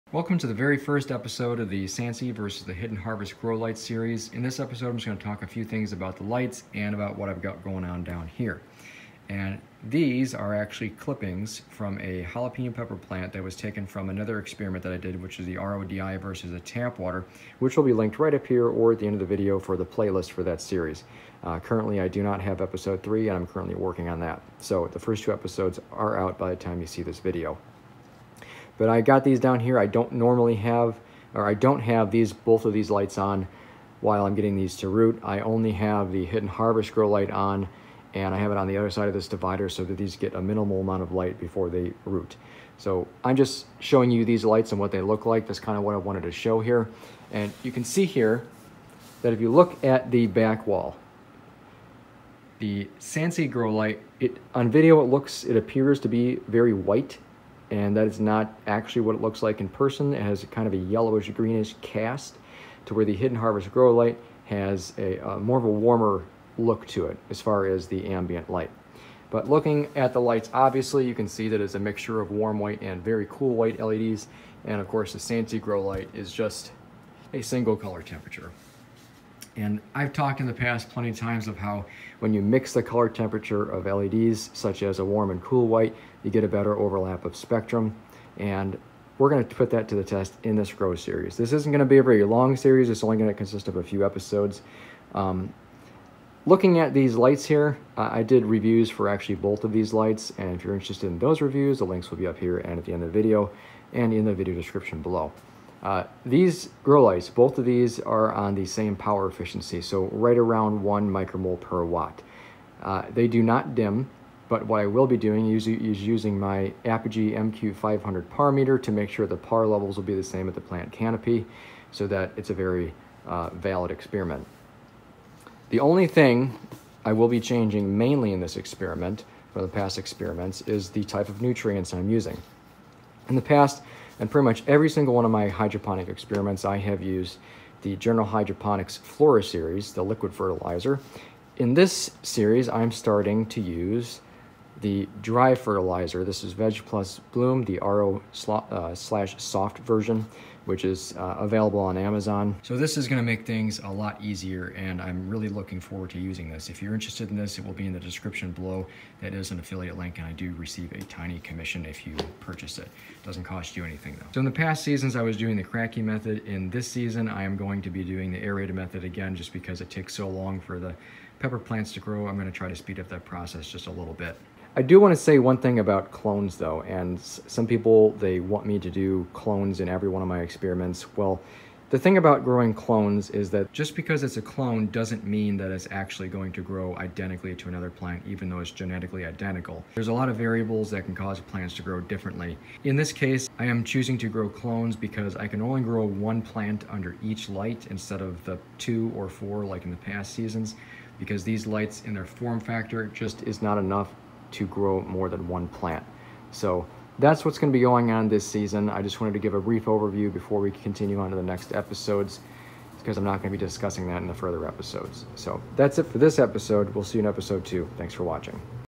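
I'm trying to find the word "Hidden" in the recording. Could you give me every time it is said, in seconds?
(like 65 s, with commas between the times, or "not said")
2 s, 36 s, 63 s.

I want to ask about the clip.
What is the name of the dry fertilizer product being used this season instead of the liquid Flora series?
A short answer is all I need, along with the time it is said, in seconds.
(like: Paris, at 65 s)
Veg Plus Bloom, at 146 s.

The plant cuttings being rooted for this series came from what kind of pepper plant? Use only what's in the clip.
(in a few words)
Jalapeno.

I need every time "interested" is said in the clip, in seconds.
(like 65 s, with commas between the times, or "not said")
100 s, 156 s.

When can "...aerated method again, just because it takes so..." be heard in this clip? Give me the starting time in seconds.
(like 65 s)
168 s.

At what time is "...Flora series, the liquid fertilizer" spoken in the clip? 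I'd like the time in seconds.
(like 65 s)
138 s.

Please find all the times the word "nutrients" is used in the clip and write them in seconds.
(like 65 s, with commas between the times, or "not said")
131 s.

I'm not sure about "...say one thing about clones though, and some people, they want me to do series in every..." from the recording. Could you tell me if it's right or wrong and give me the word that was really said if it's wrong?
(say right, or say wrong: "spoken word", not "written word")
wrong: "clones", not "series".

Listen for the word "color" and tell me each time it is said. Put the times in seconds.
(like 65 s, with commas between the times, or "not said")
77 s, 82 s.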